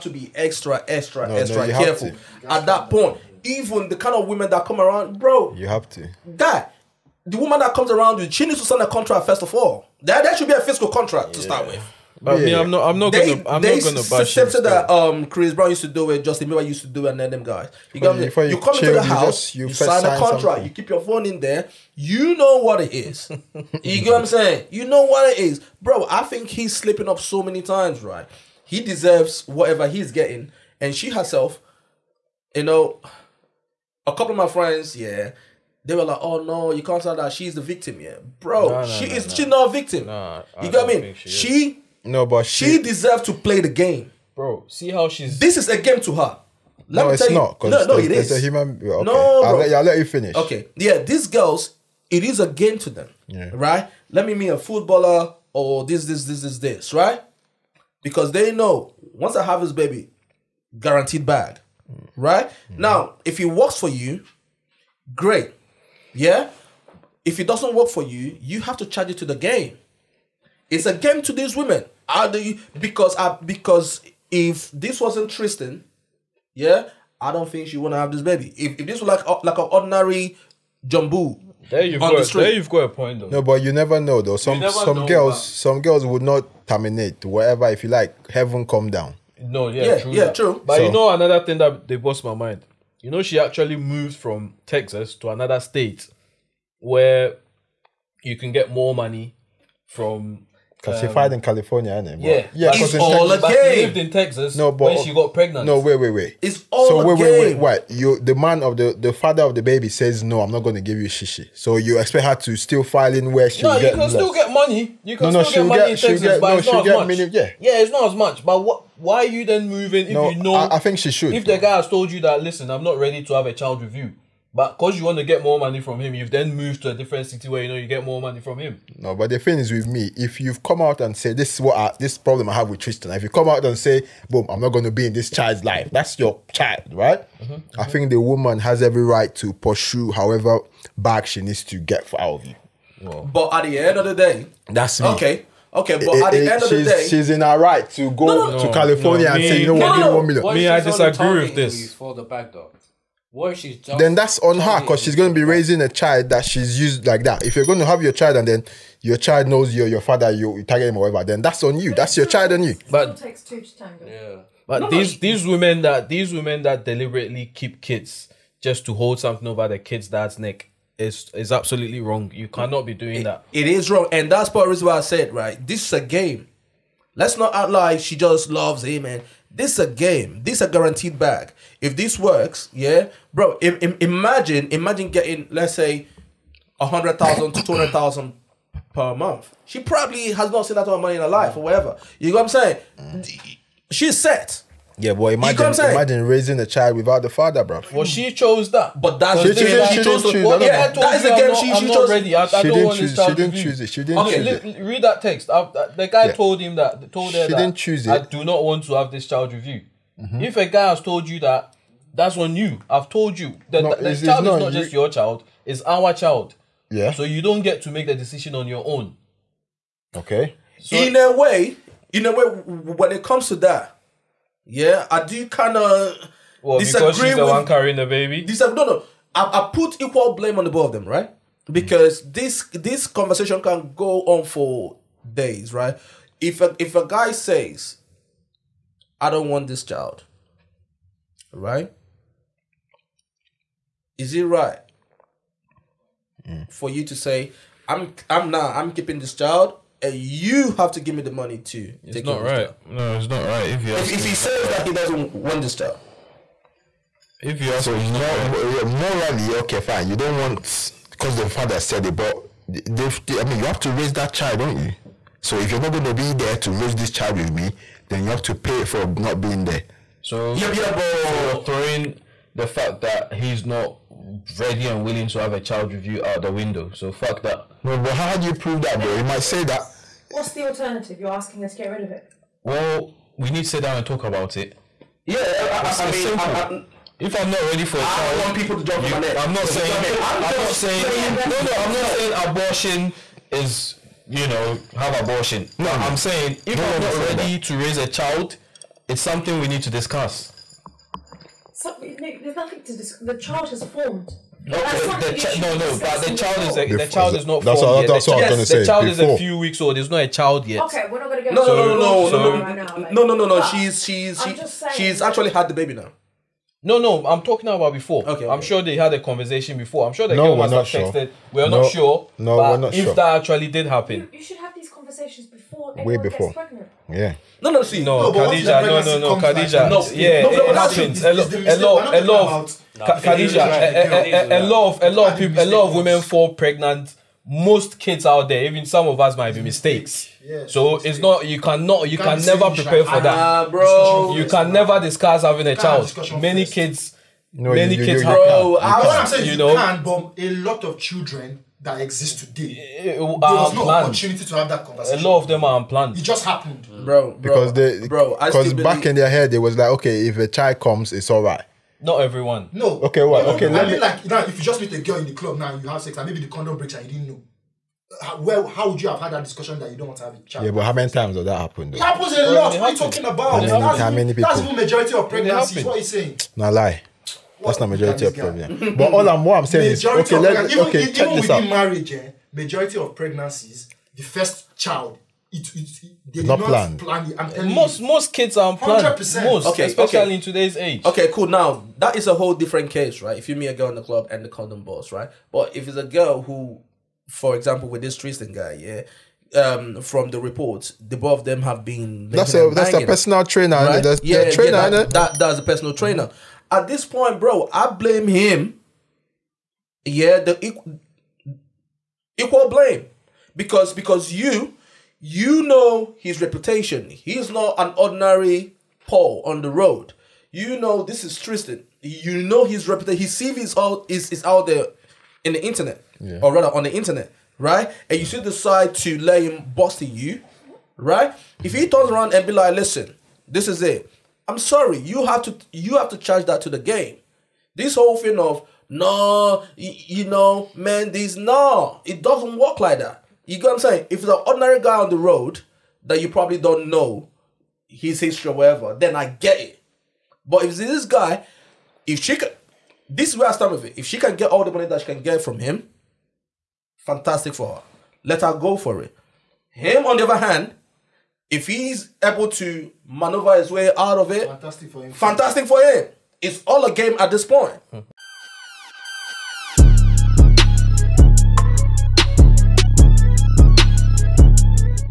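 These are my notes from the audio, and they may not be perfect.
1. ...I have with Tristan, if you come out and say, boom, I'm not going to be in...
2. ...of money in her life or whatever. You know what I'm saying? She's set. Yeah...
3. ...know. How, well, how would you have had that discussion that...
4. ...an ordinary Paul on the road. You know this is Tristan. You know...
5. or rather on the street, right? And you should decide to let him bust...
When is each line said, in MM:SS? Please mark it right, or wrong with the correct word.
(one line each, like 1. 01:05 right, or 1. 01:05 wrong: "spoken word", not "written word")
1. 02:12 right
2. 03:10 right
3. 06:07 right
4. 06:57 right
5. 07:06 wrong: "internet", not "street".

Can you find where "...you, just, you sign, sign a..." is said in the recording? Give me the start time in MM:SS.
00:19.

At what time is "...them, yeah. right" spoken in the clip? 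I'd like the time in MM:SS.
00:52.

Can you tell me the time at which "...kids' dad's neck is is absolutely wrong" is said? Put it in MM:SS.
02:49.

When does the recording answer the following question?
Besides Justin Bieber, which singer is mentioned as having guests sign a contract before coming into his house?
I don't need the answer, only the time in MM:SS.
00:15.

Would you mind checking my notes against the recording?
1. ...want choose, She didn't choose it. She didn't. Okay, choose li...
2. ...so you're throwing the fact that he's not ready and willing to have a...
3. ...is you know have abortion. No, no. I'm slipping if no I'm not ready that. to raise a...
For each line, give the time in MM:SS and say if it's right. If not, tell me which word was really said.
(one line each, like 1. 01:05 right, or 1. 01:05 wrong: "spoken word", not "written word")
1. 03:22 right
2. 04:30 right
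3. 04:53 wrong: "saying", not "slipping".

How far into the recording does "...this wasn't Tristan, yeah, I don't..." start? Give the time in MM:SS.
01:14.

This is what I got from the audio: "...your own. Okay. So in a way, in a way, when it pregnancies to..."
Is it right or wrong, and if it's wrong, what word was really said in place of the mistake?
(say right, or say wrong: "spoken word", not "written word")
wrong: "comes", not "pregnancies".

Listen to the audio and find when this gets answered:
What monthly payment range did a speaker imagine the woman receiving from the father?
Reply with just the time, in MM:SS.
03:06.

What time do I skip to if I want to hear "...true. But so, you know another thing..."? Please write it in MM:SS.
01:30.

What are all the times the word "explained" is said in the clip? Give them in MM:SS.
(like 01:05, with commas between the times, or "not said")
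not said.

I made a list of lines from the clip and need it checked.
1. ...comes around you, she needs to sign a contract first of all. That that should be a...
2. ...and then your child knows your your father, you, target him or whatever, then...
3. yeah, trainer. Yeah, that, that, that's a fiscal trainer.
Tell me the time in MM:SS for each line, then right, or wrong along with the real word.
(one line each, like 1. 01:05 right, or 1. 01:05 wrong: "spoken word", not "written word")
1. 00:07 right
2. 02:38 right
3. 06:44 wrong: "personal", not "fiscal".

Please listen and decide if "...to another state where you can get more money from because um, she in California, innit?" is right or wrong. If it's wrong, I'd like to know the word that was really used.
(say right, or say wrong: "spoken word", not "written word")
right.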